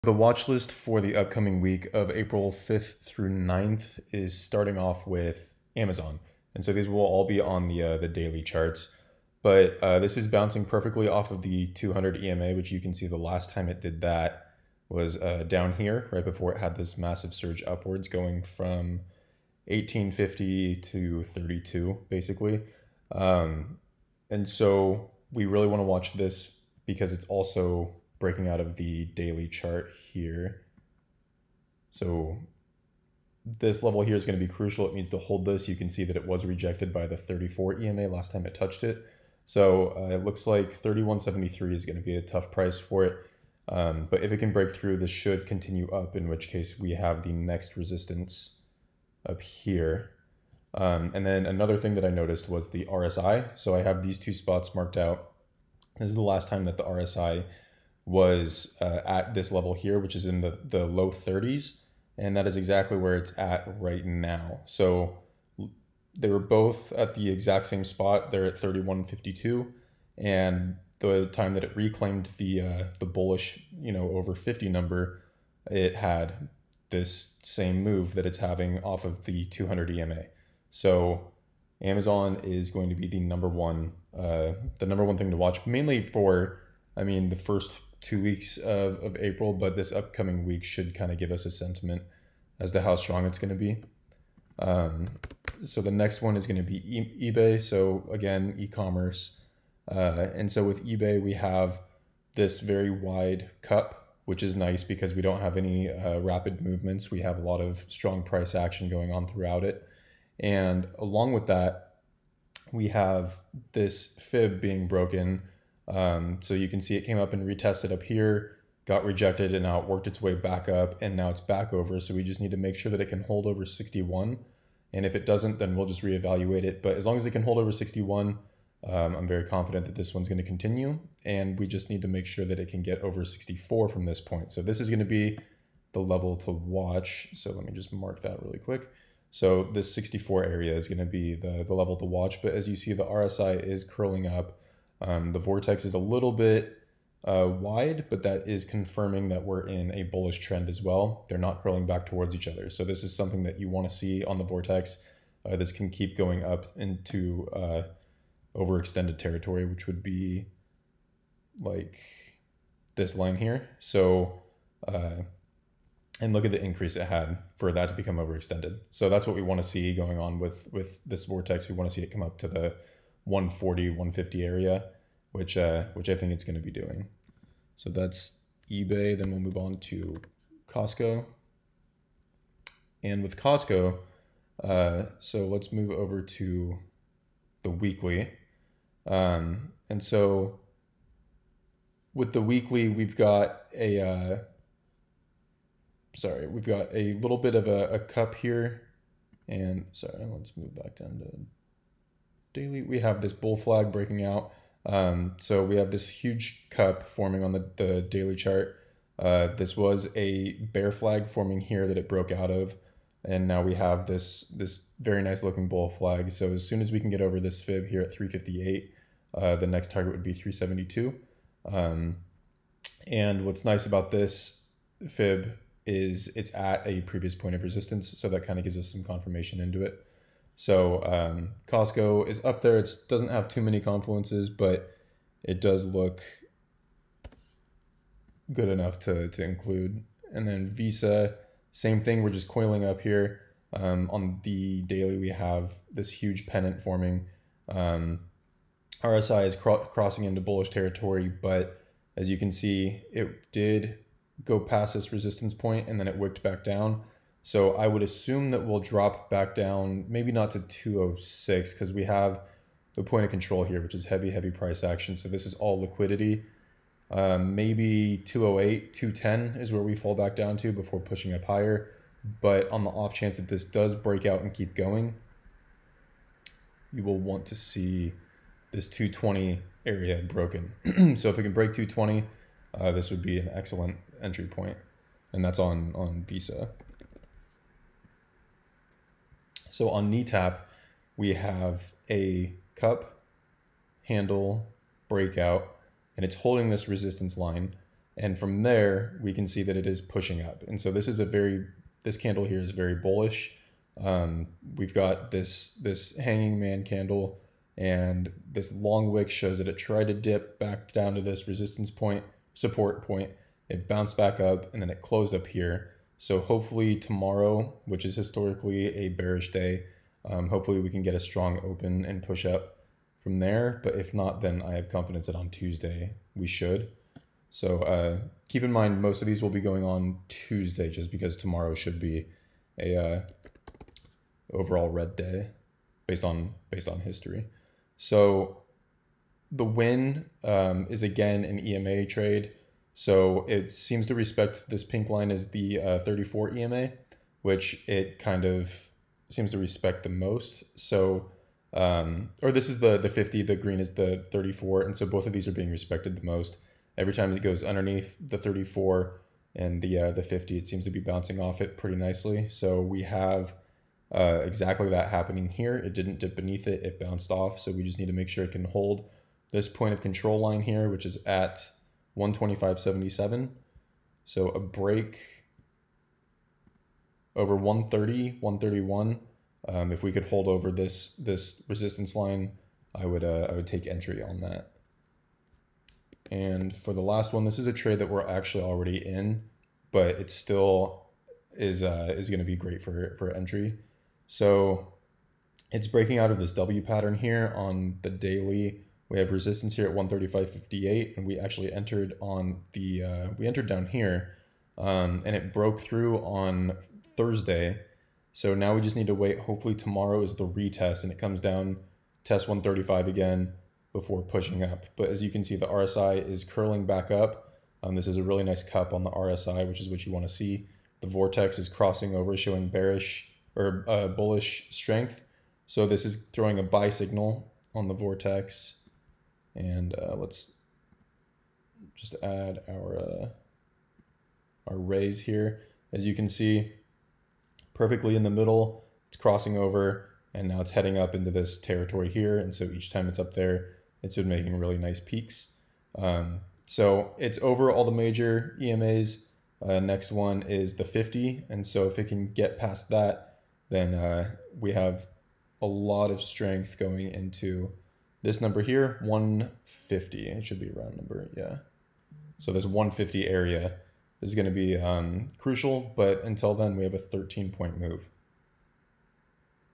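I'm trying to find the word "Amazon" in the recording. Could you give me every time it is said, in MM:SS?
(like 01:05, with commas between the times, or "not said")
00:05, 01:21.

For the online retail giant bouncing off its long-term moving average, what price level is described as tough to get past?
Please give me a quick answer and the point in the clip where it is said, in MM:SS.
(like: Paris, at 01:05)
3173, at 00:40.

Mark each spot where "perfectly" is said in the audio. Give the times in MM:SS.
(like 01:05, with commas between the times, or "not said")
00:10, 07:17.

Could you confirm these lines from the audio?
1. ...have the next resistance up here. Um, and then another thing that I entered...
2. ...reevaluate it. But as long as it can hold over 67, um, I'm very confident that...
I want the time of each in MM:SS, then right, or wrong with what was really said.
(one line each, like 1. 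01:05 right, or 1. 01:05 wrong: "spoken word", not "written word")
1. 00:46 wrong: "noticed", not "entered"
2. 02:06 wrong: "61", not "67".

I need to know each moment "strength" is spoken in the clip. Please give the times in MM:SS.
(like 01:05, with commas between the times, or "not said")
07:04, 07:36.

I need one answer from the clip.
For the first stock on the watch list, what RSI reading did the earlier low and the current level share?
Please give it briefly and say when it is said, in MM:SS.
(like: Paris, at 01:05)
31.52, at 01:08.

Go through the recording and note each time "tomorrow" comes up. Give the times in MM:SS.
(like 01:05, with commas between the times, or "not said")
05:16, 05:31, 06:49.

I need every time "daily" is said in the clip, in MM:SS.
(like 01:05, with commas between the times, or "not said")
00:08, 00:29, 03:22, 03:28, 04:04, 06:38.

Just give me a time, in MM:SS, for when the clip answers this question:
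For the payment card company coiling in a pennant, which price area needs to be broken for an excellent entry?
04:38.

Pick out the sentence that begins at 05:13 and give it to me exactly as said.
It bounced back up and then it closed up here.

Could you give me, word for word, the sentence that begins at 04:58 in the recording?
And from there, we can see that it is pushing up.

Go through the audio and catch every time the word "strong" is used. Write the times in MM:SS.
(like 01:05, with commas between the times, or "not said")
01:32, 01:47, 05:21.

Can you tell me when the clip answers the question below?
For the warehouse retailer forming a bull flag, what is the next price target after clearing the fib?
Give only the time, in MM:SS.
03:40.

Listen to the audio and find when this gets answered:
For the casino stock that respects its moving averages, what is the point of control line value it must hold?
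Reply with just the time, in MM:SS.
06:12.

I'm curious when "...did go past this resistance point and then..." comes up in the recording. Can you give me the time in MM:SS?
04:13.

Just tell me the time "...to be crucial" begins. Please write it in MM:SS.
00:34.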